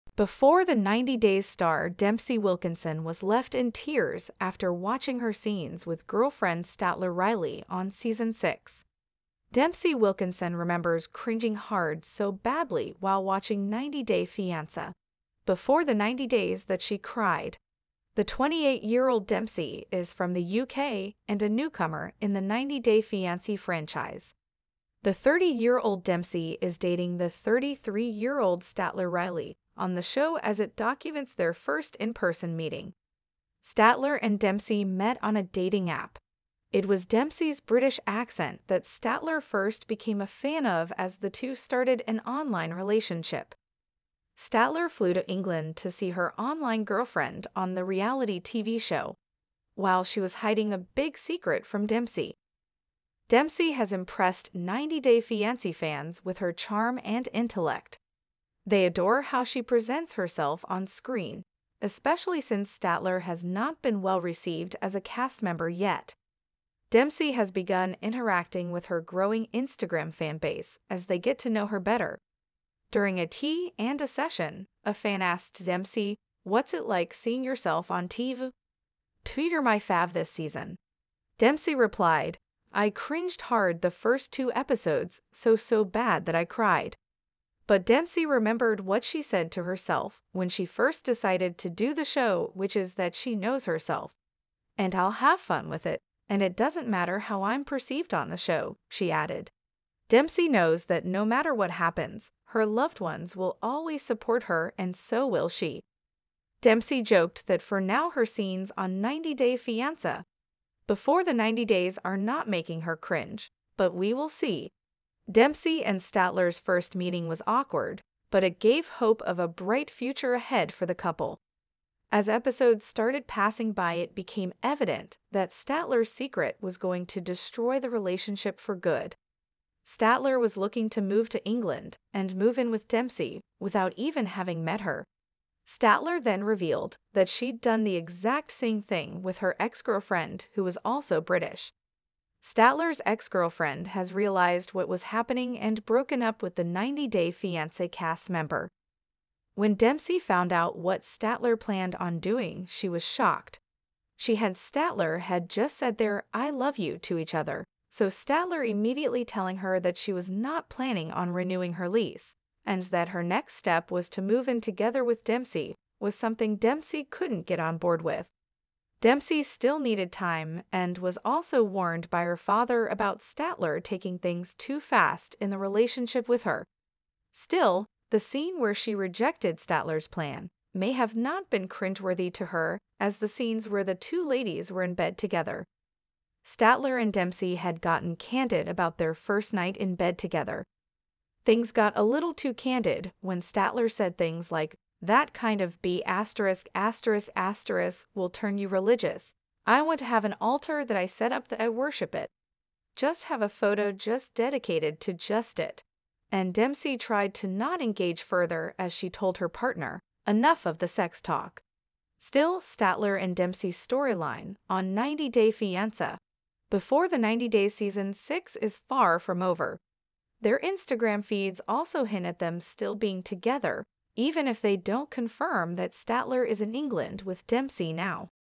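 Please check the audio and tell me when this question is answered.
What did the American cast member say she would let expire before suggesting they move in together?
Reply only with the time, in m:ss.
2:41.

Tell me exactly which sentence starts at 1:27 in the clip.
But Dempsey remembered what she said to herself when she first decided to do the show, which is that she knows herself.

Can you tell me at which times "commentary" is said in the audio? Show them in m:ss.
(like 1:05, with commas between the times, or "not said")
not said.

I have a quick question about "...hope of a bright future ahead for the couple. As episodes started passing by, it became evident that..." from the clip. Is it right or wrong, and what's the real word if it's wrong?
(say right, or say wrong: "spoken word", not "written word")
right.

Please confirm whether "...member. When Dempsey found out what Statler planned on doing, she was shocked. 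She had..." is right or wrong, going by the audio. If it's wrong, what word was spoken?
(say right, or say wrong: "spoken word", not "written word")
right.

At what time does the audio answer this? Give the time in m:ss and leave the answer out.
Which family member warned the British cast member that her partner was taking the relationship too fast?
2:52.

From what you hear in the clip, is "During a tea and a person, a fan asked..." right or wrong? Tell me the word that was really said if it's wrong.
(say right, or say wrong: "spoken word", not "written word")
wrong: "session", not "person".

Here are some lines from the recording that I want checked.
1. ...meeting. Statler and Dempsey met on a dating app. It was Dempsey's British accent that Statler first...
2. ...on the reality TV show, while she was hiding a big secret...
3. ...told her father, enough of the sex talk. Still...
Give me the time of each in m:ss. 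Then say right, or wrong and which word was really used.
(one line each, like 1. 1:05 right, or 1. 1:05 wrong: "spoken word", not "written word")
1. 0:32 right
2. 0:47 right
3. 3:29 wrong: "partner", not "father".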